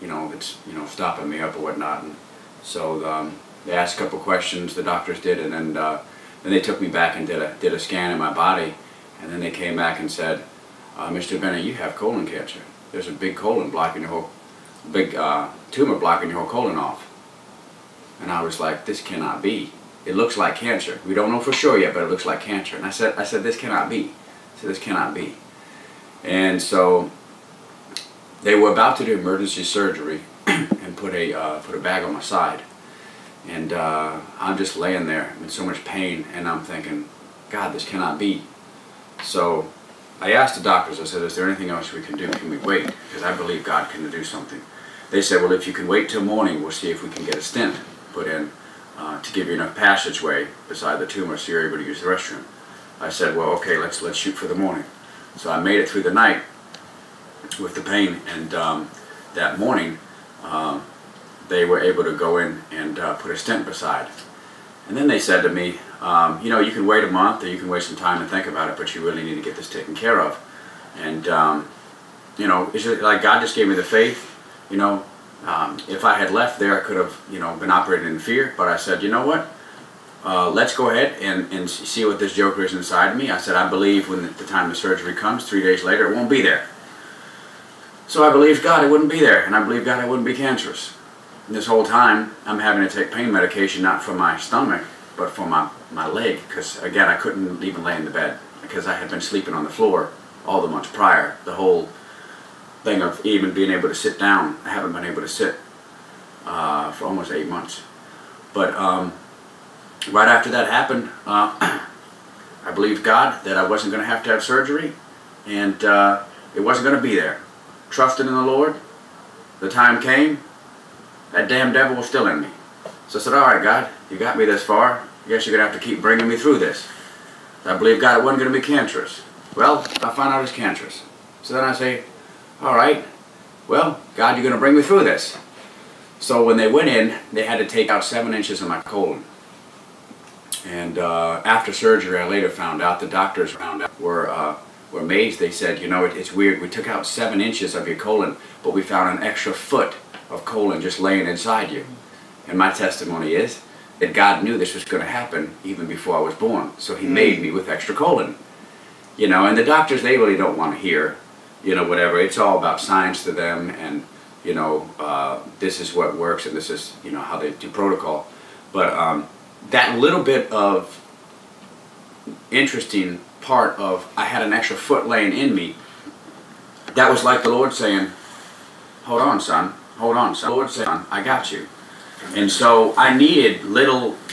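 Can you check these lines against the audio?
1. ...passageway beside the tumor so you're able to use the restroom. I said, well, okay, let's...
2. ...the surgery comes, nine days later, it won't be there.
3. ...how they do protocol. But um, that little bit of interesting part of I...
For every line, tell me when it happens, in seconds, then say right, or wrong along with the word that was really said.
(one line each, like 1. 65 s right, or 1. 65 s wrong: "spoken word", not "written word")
1. 49 s right
2. 84 s wrong: "three", not "nine"
3. 167 s right.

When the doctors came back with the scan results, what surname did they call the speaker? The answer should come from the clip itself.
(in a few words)
Bennett.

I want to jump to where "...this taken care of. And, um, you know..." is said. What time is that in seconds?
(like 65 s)
69 s.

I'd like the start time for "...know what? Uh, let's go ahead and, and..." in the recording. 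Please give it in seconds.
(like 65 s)
79 s.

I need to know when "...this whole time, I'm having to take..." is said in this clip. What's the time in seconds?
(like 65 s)
91 s.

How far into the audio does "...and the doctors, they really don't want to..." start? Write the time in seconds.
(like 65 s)
159 s.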